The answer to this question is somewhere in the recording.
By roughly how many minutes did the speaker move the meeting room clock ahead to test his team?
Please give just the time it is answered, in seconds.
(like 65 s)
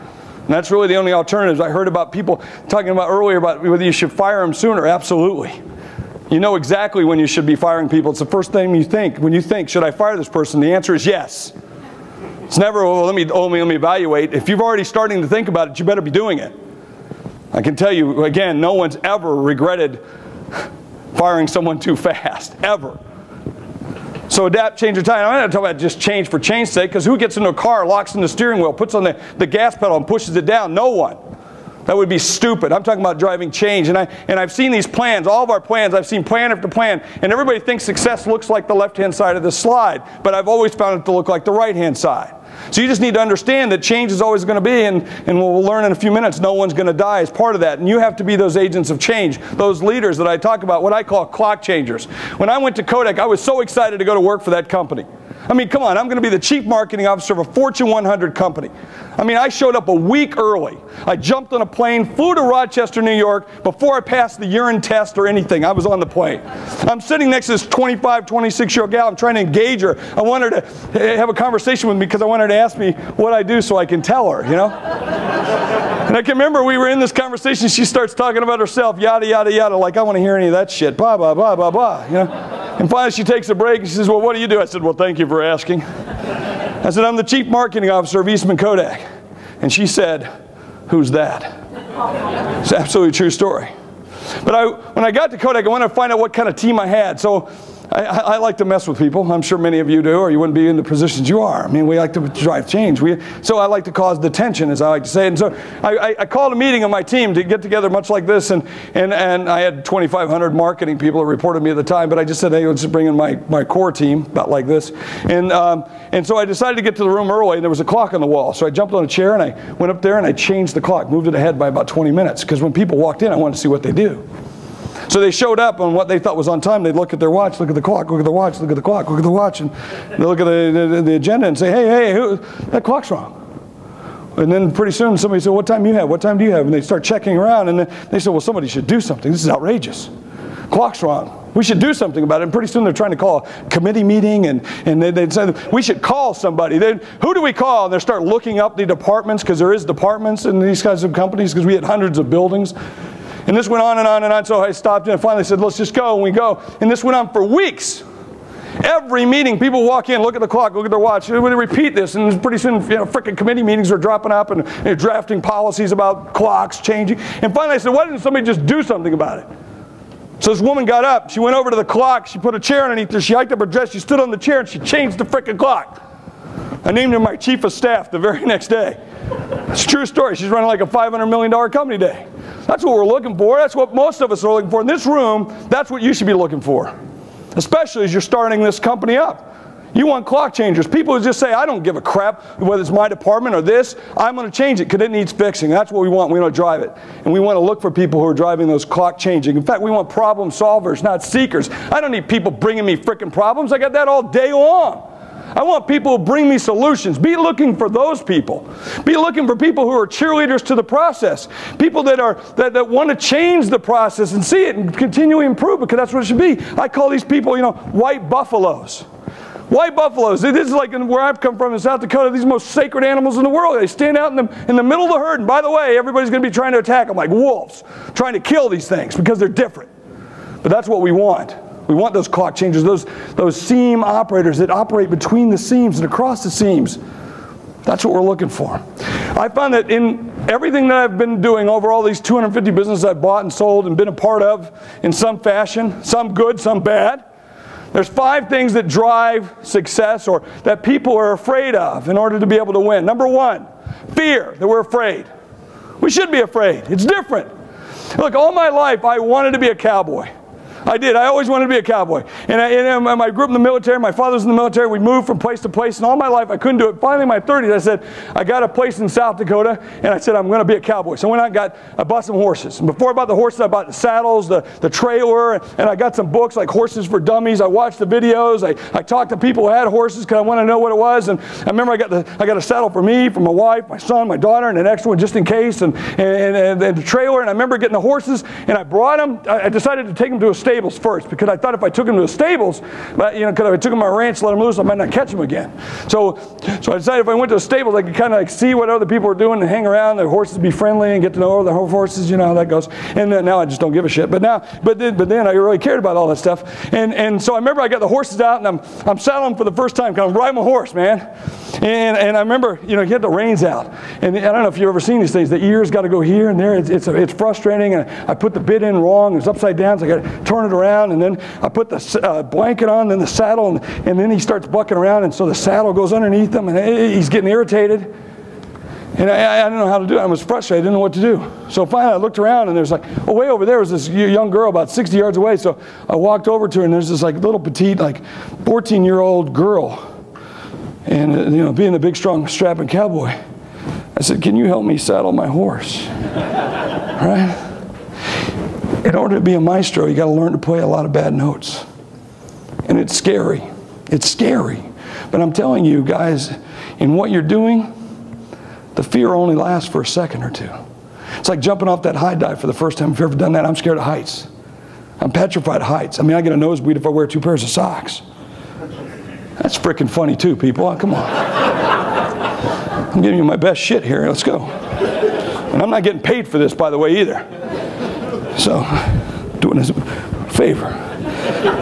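121 s.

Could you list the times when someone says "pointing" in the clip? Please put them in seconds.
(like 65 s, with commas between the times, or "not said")
not said.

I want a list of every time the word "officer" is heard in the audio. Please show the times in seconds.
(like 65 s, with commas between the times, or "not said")
57 s, 87 s.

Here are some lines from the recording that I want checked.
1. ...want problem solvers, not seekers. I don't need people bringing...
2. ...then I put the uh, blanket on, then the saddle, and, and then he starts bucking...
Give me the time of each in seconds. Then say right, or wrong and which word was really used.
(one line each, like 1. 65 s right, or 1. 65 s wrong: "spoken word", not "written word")
1. 199 s right
2. 321 s right.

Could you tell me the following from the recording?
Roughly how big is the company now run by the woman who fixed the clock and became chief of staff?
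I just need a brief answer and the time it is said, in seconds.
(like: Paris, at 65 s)
$500 million, at 180 s.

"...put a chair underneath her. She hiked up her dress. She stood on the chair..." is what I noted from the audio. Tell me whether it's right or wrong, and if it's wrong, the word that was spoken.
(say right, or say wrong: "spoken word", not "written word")
right.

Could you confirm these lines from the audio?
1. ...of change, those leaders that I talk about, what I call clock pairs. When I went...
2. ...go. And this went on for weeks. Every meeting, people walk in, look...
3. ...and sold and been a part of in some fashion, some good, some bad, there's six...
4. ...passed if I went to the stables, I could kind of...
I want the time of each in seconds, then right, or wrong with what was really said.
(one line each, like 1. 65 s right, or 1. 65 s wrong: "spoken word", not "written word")
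1. 48 s wrong: "changers", not "pairs"
2. 156 s right
3. 243 s wrong: "five", not "six"
4. 296 s wrong: "decided", not "passed".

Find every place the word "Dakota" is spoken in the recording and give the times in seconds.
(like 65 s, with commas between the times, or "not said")
222 s, 269 s.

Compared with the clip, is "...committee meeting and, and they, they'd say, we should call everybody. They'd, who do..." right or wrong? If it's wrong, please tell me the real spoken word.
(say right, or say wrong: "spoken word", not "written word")
wrong: "somebody", not "everybody".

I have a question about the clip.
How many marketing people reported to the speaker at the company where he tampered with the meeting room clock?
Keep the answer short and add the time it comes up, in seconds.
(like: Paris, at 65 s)
2,500, at 109 s.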